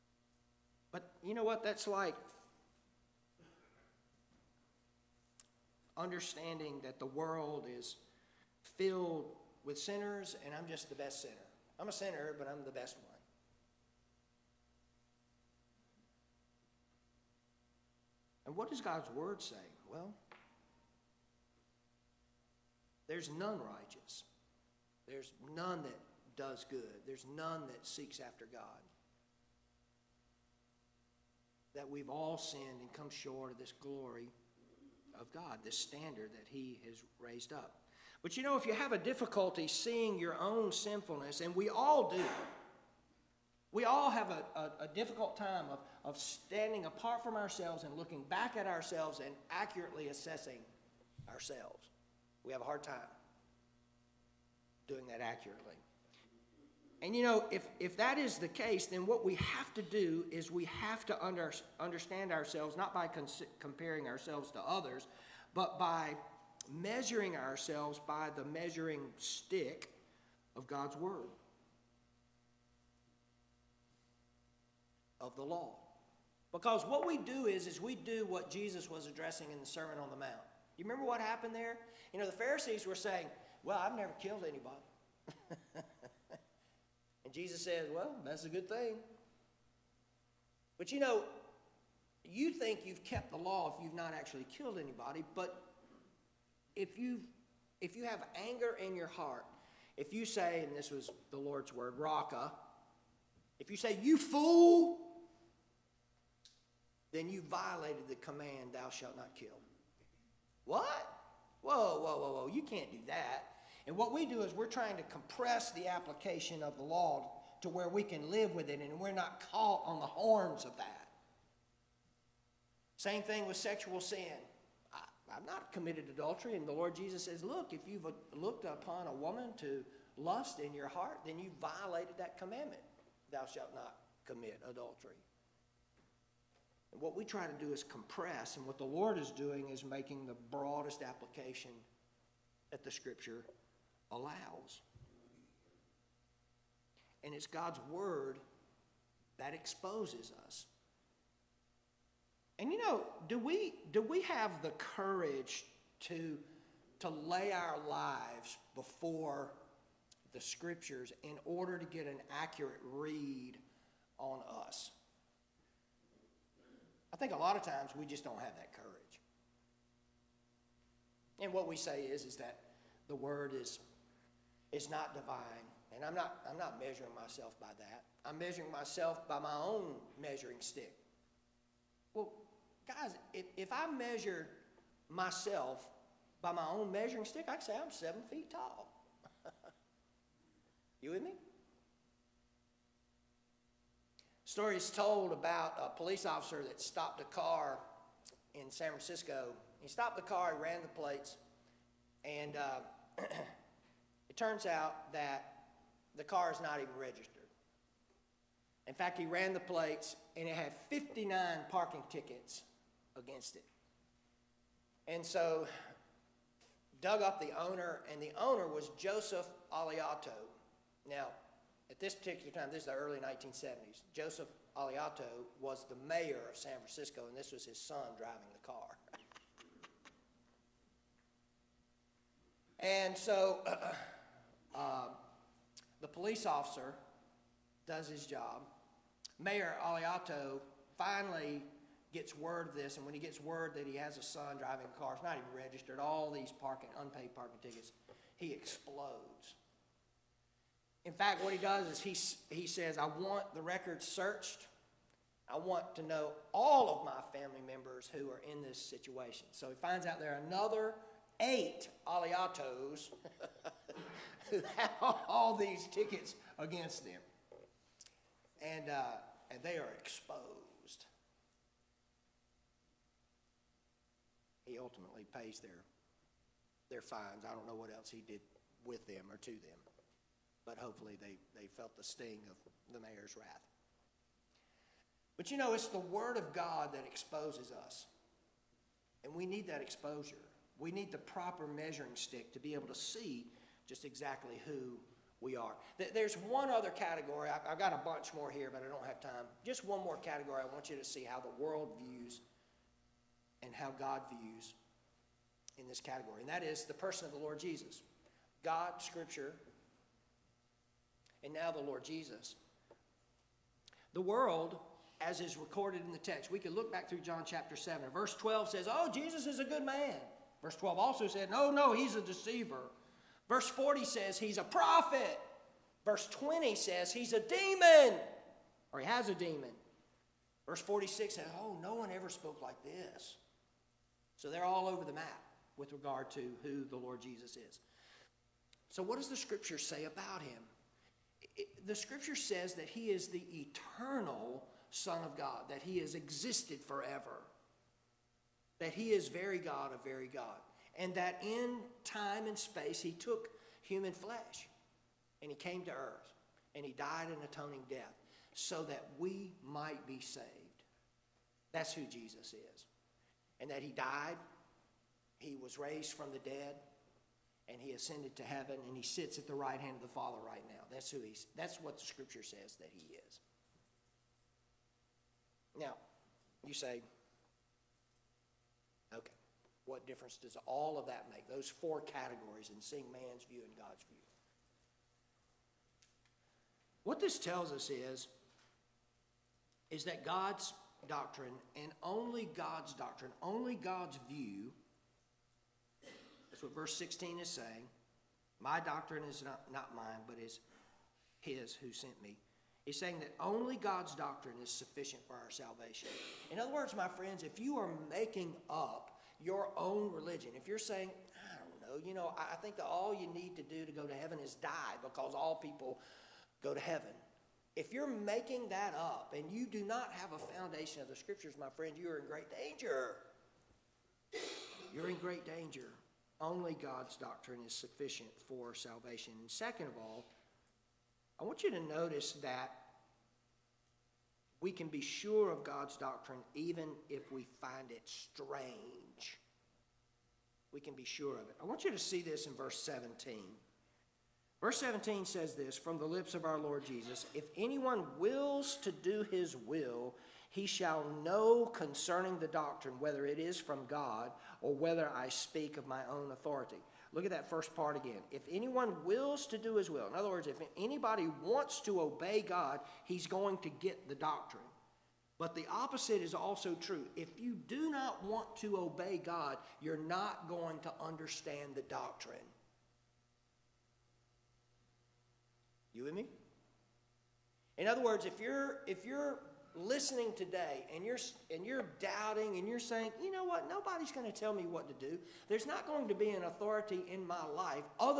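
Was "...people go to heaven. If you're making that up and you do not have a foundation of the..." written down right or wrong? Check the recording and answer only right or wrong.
right.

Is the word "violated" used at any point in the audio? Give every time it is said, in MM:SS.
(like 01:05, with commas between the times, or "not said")
01:47, 02:11.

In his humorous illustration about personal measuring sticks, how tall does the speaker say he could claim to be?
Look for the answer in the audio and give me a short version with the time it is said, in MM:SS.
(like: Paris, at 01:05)
7 feet, at 03:07.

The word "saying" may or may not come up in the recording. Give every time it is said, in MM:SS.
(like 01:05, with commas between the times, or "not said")
01:22, 06:37, 06:42, 06:50, 08:02.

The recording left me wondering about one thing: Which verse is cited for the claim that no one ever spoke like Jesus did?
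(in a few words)
Verse 46.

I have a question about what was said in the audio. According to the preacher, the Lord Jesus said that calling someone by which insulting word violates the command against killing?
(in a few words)
raka.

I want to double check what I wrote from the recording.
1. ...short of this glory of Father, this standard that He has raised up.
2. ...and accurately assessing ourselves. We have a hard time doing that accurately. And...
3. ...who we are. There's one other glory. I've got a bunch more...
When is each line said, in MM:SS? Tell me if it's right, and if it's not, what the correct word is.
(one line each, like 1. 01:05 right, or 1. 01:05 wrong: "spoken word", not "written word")
1. 00:33 wrong: "God", not "Father"
2. 00:49 right
3. 04:54 wrong: "category", not "glory".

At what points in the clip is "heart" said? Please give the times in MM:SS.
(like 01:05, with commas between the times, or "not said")
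01:39, 02:10.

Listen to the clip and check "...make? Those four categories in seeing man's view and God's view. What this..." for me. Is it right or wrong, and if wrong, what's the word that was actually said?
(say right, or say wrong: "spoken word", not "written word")
right.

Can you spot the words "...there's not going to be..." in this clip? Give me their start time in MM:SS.
08:05.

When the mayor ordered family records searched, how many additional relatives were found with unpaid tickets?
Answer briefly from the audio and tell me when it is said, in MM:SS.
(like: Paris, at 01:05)
8, at 04:21.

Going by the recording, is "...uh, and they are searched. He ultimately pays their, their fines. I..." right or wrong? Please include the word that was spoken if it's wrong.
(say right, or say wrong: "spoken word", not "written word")
wrong: "exposed", not "searched".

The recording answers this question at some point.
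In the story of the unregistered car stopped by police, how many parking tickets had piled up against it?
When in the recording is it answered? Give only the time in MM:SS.
03:30.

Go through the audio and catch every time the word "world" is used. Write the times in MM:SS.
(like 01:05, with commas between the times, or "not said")
00:07, 05:01, 05:14.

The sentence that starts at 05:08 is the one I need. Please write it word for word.
God, Scripture, and now the Lord Jesus.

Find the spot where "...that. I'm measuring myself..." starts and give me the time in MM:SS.
02:57.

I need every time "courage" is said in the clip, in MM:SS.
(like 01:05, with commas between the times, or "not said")
02:34, 02:48.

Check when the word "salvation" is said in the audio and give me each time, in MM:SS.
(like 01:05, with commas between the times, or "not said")
06:45, 07:08.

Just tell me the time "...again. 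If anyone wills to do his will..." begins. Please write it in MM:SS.
07:37.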